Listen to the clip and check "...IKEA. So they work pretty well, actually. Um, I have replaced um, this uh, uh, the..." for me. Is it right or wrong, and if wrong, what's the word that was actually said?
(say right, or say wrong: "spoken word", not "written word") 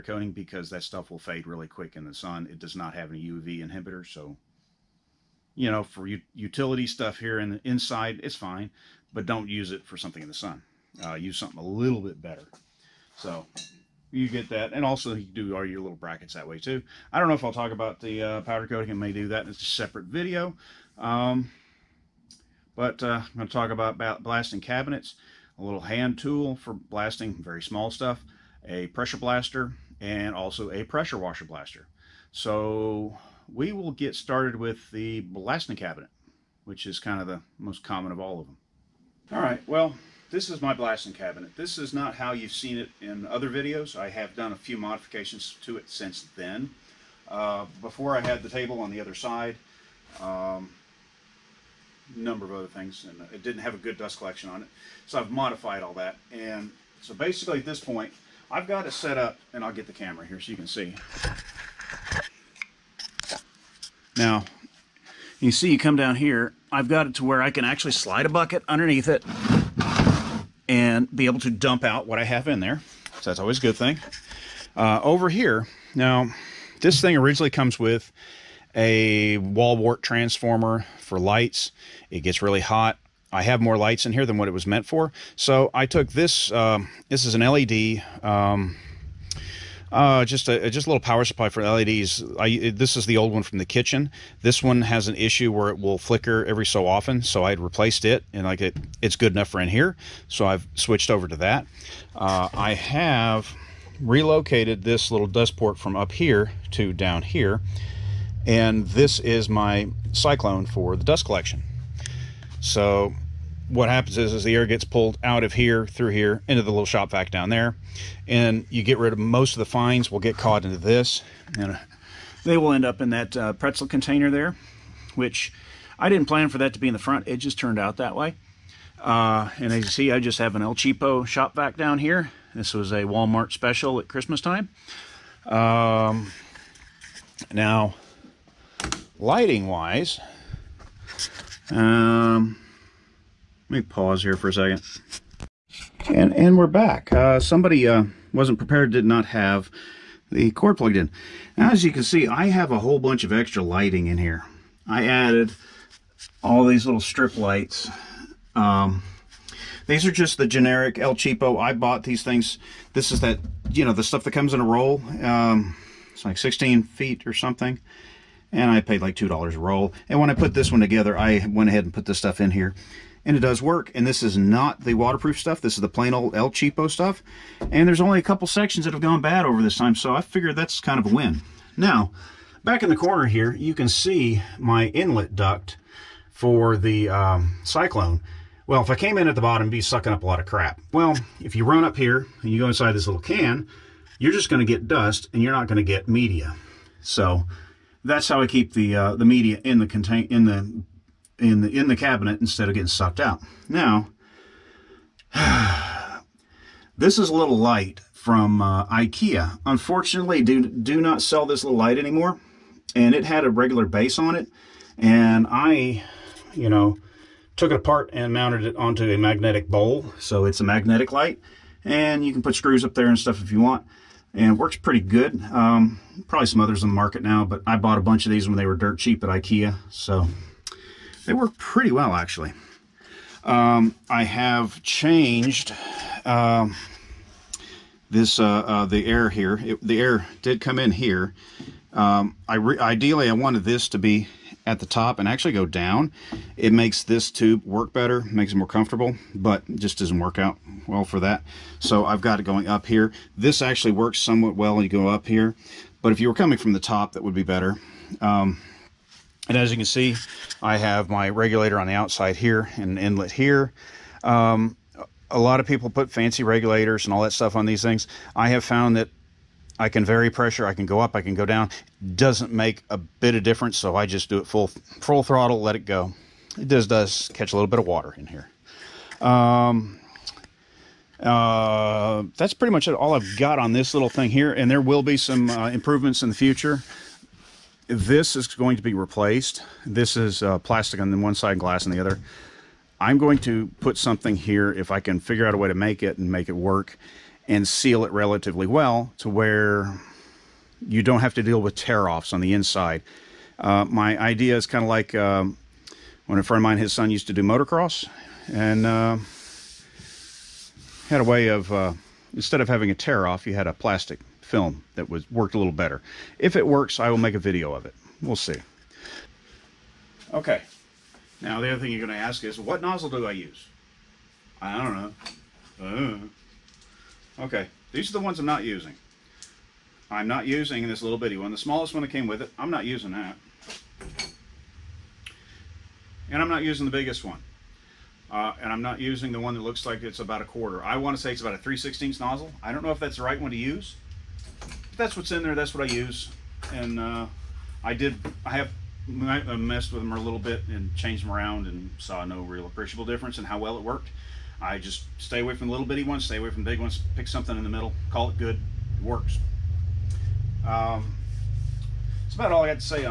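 wrong: "changed", not "replaced".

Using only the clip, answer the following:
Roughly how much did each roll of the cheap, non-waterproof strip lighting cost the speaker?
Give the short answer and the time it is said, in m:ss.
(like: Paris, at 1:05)
$2, at 2:49.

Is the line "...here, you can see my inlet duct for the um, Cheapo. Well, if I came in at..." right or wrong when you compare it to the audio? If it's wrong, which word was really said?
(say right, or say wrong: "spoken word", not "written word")
wrong: "Cyclone", not "Cheapo".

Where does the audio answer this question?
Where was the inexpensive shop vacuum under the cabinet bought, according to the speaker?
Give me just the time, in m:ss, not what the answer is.
2:13.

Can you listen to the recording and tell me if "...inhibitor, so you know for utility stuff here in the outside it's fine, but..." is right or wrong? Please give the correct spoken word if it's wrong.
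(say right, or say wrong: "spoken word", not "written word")
wrong: "inside", not "outside".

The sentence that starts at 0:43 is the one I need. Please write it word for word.
I have done a few modifications to it since then.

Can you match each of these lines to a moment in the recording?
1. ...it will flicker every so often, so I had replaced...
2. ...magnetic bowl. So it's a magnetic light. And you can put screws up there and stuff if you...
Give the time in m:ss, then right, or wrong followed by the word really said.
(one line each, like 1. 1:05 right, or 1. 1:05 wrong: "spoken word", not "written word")
1. 1:35 right
2. 3:39 right.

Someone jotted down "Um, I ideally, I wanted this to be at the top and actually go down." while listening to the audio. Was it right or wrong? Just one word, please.
right.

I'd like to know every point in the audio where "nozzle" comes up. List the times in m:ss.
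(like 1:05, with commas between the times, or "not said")
5:22, 5:42.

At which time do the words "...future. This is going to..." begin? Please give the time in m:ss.
4:46.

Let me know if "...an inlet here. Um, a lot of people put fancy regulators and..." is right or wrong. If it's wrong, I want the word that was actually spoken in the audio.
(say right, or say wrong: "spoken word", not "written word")
right.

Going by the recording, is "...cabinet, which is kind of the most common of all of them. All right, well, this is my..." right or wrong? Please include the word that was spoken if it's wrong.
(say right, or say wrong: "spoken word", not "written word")
right.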